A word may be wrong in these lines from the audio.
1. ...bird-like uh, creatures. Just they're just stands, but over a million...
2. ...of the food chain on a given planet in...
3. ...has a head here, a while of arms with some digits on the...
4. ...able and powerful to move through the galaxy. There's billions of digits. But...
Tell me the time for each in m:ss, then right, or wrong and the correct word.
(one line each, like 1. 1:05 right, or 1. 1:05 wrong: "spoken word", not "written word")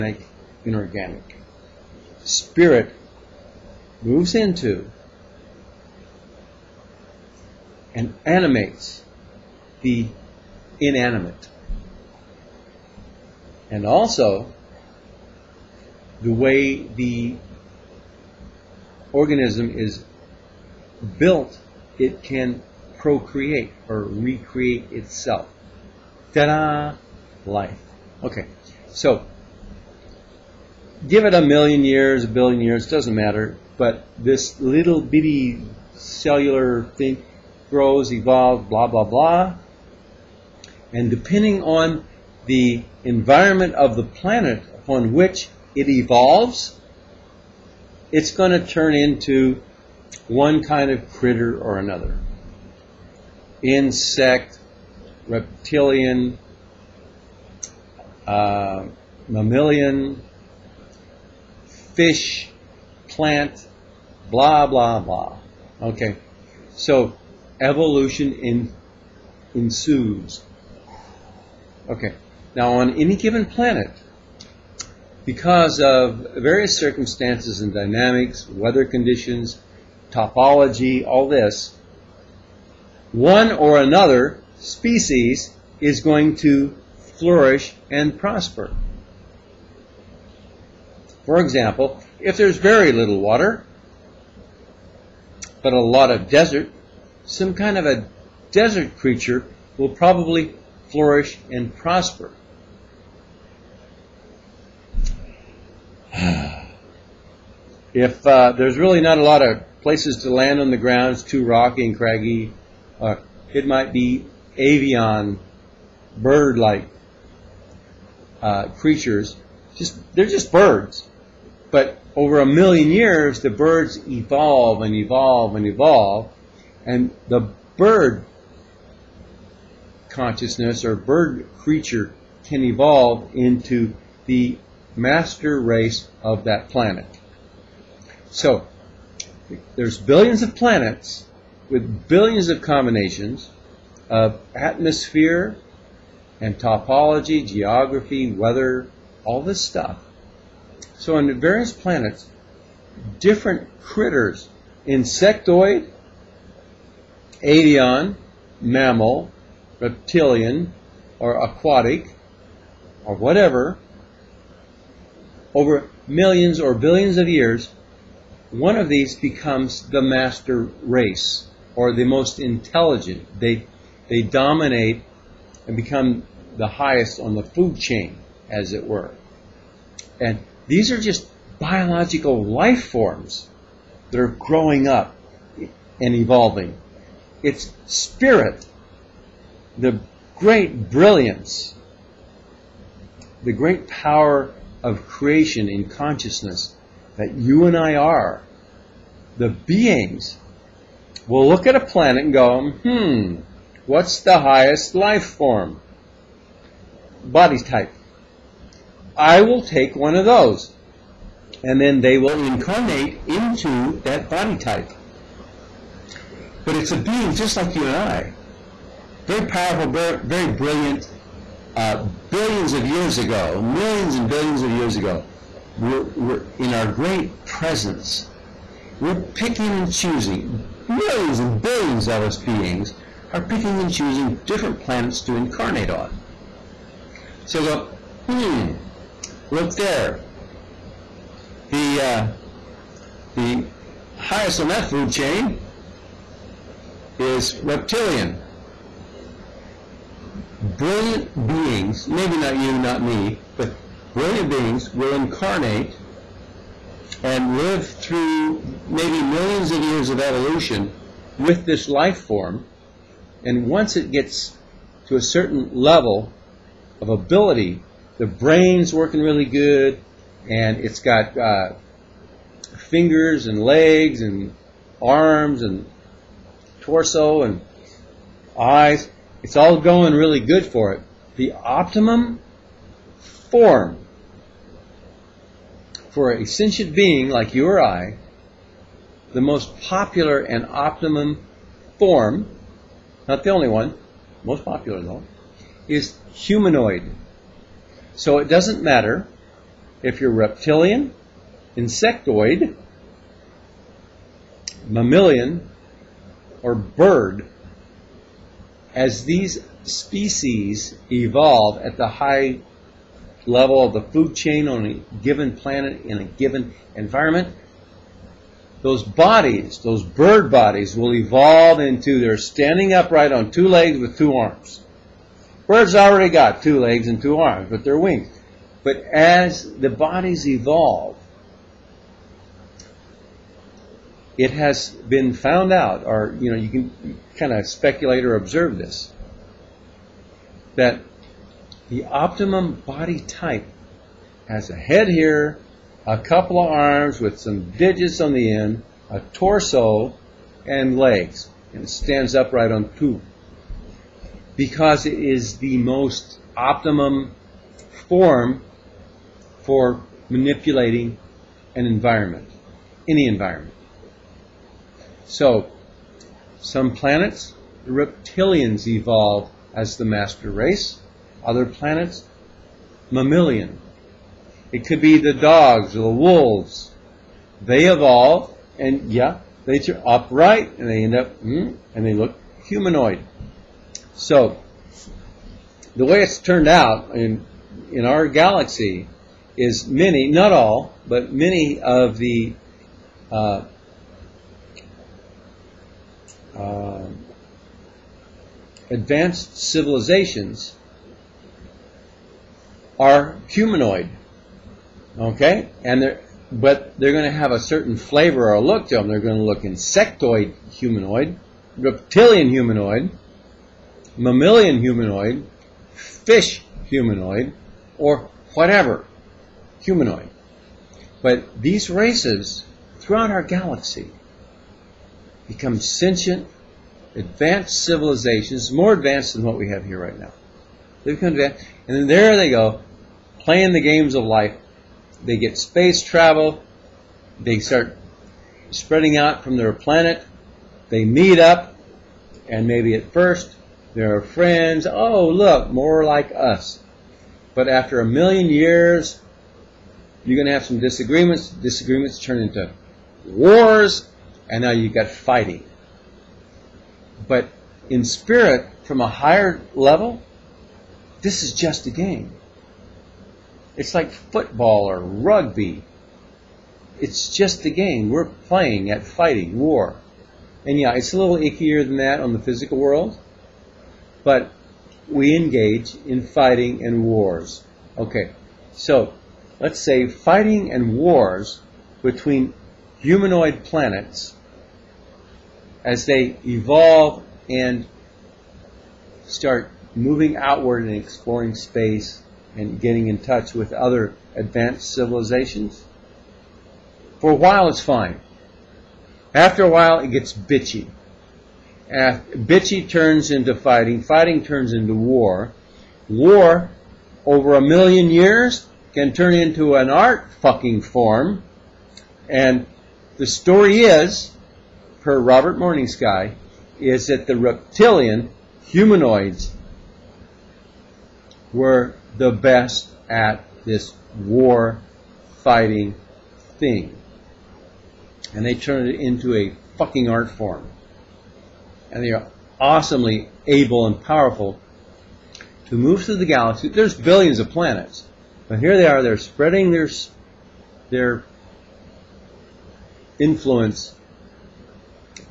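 1. 1:56 wrong: "birds", not "stands"
2. 5:13 right
3. 5:44 wrong: "couple", not "while"
4. 8:53 wrong: "planets", not "digits".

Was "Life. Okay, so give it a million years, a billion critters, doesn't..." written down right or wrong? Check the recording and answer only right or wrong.
wrong.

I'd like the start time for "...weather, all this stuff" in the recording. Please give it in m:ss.
2:28.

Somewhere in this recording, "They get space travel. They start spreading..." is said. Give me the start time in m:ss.
7:15.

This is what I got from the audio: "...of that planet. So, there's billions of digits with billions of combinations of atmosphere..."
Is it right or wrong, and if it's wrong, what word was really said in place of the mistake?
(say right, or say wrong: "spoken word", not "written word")
wrong: "planets", not "digits".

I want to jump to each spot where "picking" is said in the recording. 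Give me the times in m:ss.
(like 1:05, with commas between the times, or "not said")
3:49, 3:53.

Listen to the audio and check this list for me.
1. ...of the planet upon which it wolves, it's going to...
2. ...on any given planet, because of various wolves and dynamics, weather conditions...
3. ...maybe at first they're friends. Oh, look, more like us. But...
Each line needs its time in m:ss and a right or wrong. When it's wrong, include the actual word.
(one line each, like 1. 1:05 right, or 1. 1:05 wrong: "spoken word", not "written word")
1. 0:43 wrong: "evolves", not "wolves"
2. 1:12 wrong: "circumstances", not "wolves"
3. 7:22 right.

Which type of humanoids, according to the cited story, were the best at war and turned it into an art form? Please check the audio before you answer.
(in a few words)
reptilian humanoids.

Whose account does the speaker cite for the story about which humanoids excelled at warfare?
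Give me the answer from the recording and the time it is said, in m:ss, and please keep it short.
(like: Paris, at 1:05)
Robert Morning Sky, at 8:35.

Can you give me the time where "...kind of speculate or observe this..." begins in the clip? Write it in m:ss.
5:37.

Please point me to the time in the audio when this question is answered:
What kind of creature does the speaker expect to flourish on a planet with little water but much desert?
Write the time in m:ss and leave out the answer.
1:37.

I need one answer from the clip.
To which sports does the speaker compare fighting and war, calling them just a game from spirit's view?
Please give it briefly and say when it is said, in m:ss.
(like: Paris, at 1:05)
football or rugby, at 7:44.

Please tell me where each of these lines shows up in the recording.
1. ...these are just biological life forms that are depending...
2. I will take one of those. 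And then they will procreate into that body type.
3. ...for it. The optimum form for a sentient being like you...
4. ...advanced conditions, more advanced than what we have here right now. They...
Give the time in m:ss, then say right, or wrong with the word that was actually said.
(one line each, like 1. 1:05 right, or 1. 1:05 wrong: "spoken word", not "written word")
1. 3:00 wrong: "growing", not "depending"
2. 3:29 wrong: "incarnate", not "procreate"
3. 4:40 right
4. 7:07 wrong: "civilizations", not "conditions".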